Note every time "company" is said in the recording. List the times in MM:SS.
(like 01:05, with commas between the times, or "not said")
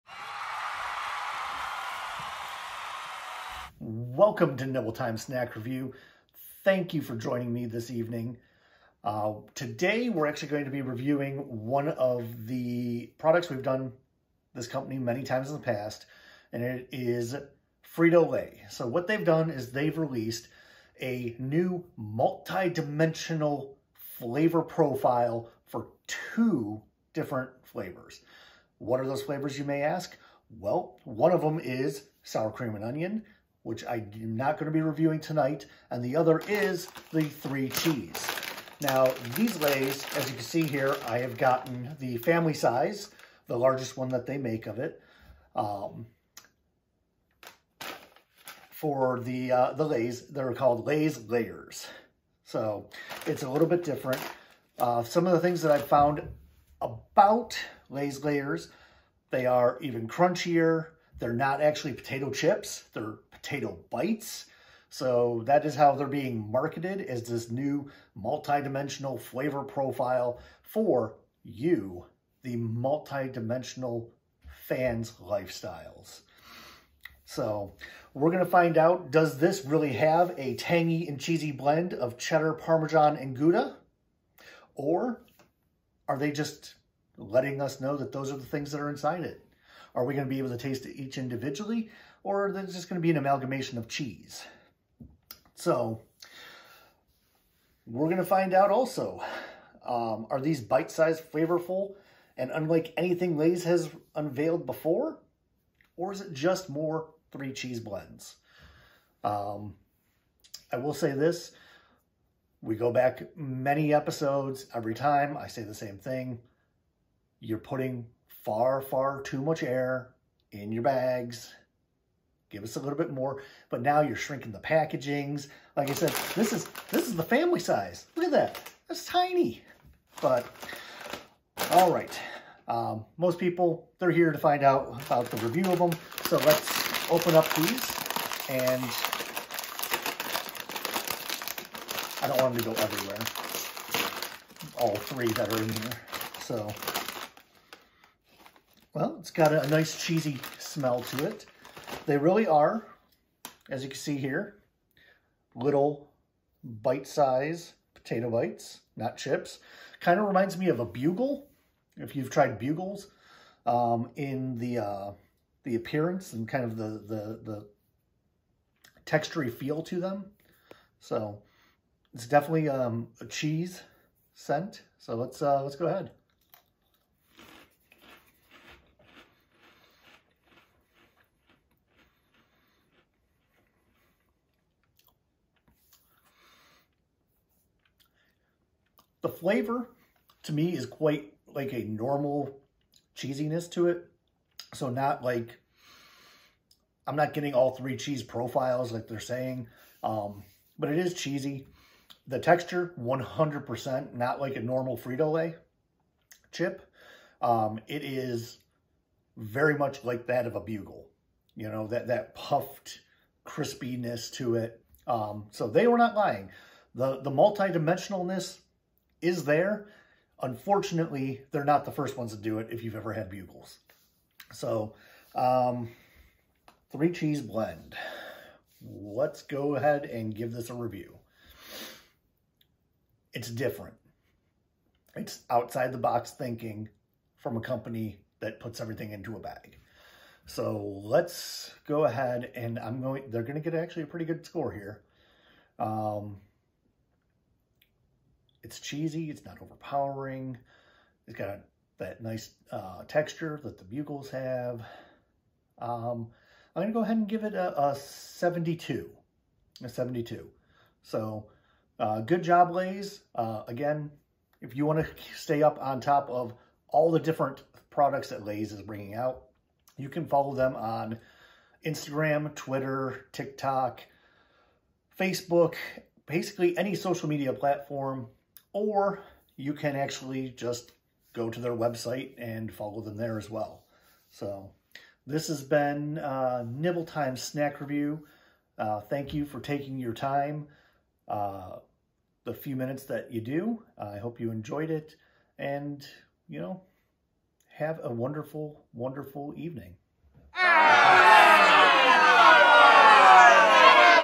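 00:14, 03:57.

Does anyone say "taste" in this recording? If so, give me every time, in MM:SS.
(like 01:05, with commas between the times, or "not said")
01:30.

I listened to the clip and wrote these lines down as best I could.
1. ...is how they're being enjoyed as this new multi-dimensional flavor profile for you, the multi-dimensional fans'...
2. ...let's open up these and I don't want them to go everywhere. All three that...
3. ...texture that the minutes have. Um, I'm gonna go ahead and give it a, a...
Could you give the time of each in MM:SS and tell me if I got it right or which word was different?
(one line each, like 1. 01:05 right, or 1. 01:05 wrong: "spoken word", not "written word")
1. 01:05 wrong: "marketed", not "enjoyed"
2. 02:16 right
3. 04:13 wrong: "bugles", not "minutes".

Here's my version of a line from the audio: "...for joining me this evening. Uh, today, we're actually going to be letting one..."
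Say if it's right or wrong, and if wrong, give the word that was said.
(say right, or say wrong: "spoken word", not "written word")
wrong: "reviewing", not "letting".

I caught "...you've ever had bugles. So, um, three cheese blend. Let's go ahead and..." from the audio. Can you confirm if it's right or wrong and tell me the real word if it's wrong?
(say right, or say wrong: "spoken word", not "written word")
right.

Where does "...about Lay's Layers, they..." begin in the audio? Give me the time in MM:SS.
00:56.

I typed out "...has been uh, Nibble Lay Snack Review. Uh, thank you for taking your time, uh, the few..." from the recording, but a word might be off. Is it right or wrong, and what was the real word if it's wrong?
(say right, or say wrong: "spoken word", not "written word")
wrong: "Time", not "Lay".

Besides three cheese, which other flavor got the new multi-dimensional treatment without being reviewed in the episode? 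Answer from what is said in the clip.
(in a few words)
Sour cream and onion.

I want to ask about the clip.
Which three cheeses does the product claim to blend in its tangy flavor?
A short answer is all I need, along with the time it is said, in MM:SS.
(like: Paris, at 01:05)
Cheddar, parmesan, and gouda, at 01:22.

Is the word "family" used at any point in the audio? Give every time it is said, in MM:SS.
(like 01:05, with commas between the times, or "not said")
00:42, 02:07.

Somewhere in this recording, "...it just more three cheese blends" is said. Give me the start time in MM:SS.
01:46.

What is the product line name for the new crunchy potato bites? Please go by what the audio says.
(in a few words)
Lay's Layers.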